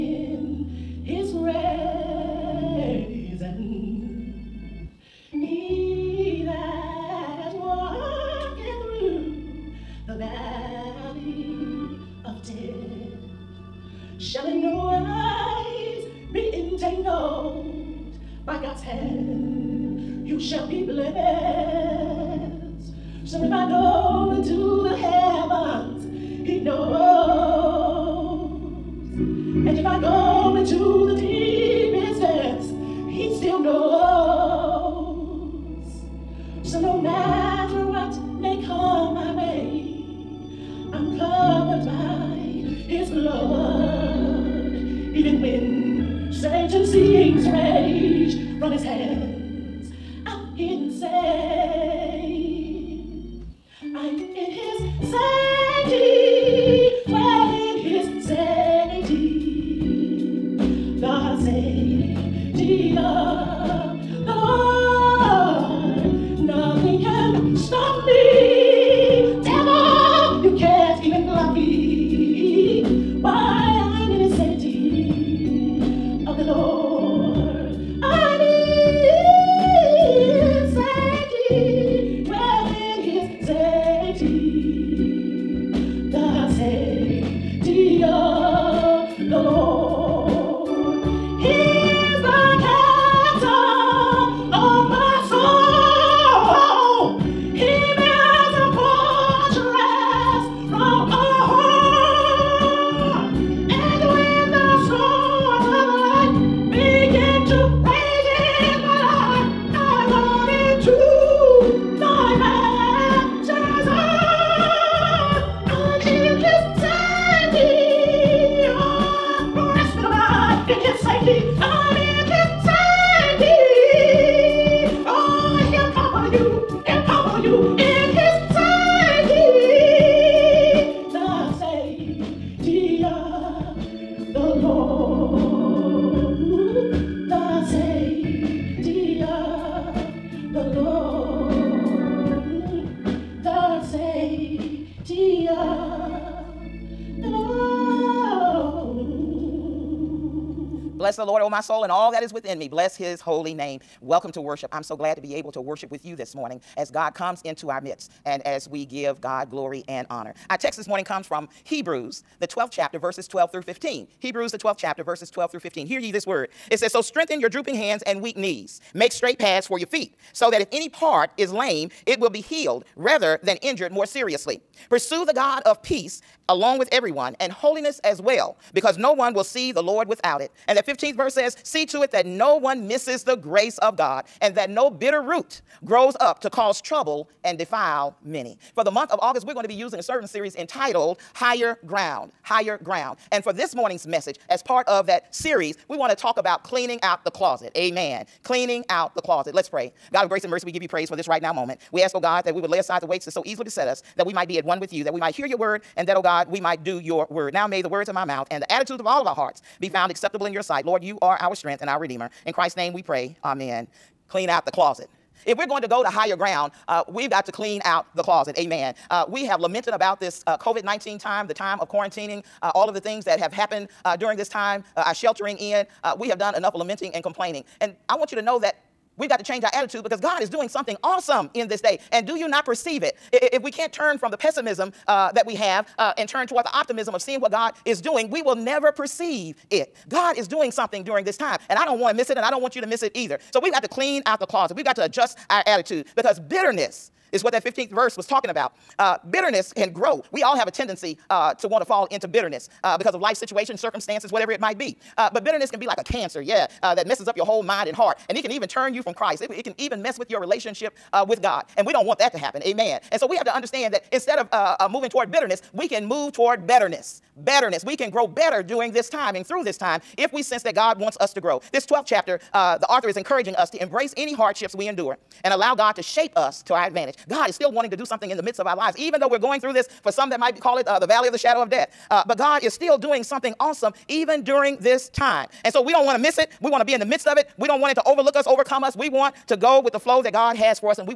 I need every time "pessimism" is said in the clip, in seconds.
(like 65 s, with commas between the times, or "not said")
234 s.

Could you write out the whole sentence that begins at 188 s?
For the month of August, we're going to be using a sermon series entitled Higher Ground higher ground.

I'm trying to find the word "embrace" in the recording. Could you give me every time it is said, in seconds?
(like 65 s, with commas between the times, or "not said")
273 s.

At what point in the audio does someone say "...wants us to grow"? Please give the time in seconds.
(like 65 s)
270 s.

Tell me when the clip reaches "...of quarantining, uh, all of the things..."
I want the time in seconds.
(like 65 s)
221 s.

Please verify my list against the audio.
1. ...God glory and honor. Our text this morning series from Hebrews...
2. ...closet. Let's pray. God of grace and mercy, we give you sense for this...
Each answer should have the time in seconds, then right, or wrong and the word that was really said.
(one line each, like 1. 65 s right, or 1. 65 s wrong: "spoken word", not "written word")
1. 159 s wrong: "comes", not "series"
2. 199 s wrong: "praise", not "sense".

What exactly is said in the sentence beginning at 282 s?
Uh, but God is still doing something awesome, even during this time.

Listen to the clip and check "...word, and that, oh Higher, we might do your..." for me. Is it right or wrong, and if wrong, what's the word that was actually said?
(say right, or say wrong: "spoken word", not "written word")
wrong: "God", not "Higher".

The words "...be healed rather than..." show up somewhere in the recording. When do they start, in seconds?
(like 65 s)
172 s.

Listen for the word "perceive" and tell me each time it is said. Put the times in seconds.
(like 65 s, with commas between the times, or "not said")
232 s, 238 s.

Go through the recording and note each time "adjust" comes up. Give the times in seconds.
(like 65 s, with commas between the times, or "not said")
245 s.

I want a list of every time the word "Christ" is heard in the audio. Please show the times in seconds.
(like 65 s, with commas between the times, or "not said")
212 s, 259 s.